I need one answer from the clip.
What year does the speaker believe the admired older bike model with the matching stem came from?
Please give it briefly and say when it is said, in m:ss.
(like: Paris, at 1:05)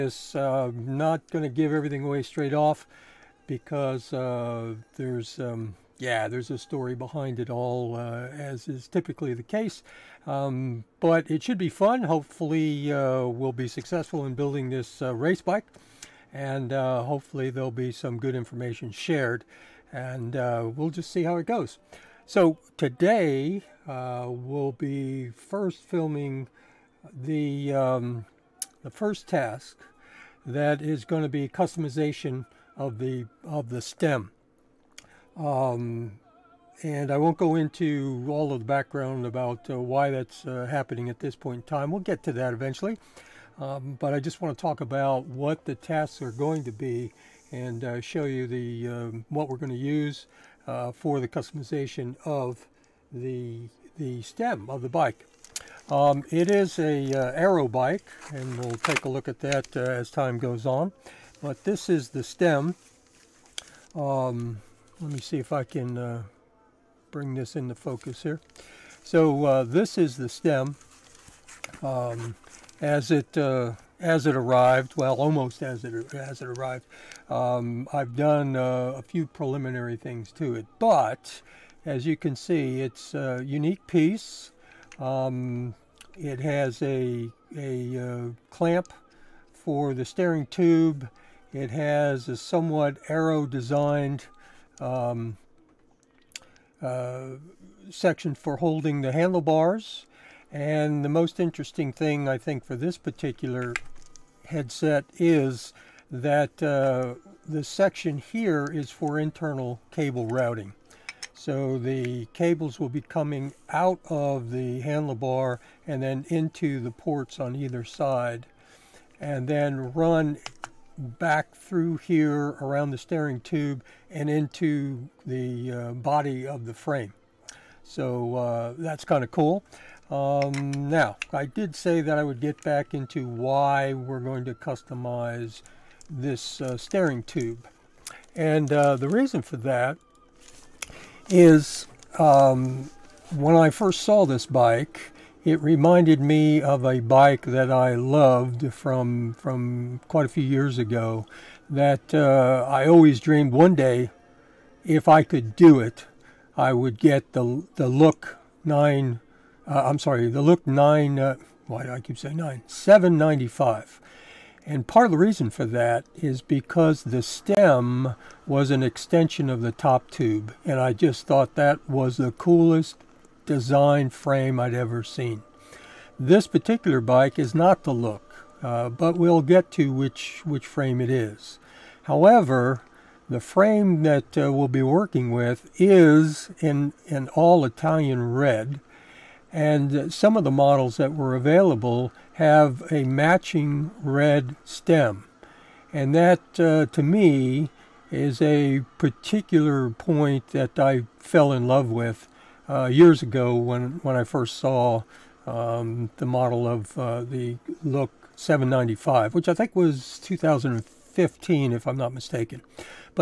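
2015, at 3:30.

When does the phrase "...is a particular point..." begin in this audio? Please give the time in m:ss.
3:18.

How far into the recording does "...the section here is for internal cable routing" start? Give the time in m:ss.
1:47.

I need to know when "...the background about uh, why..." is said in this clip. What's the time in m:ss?
0:38.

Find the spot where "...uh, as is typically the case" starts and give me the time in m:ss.
0:07.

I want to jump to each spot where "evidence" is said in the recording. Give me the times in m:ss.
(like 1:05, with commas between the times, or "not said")
not said.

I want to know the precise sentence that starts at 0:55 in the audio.
Um, it is a uh, aero bike, and we'll take a look at that uh, as time goes on.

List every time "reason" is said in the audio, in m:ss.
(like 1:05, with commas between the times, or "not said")
2:19, 2:45.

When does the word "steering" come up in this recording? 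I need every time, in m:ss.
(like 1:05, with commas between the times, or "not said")
1:30, 2:02, 2:16.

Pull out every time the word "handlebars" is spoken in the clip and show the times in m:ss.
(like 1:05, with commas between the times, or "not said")
1:39, 1:54.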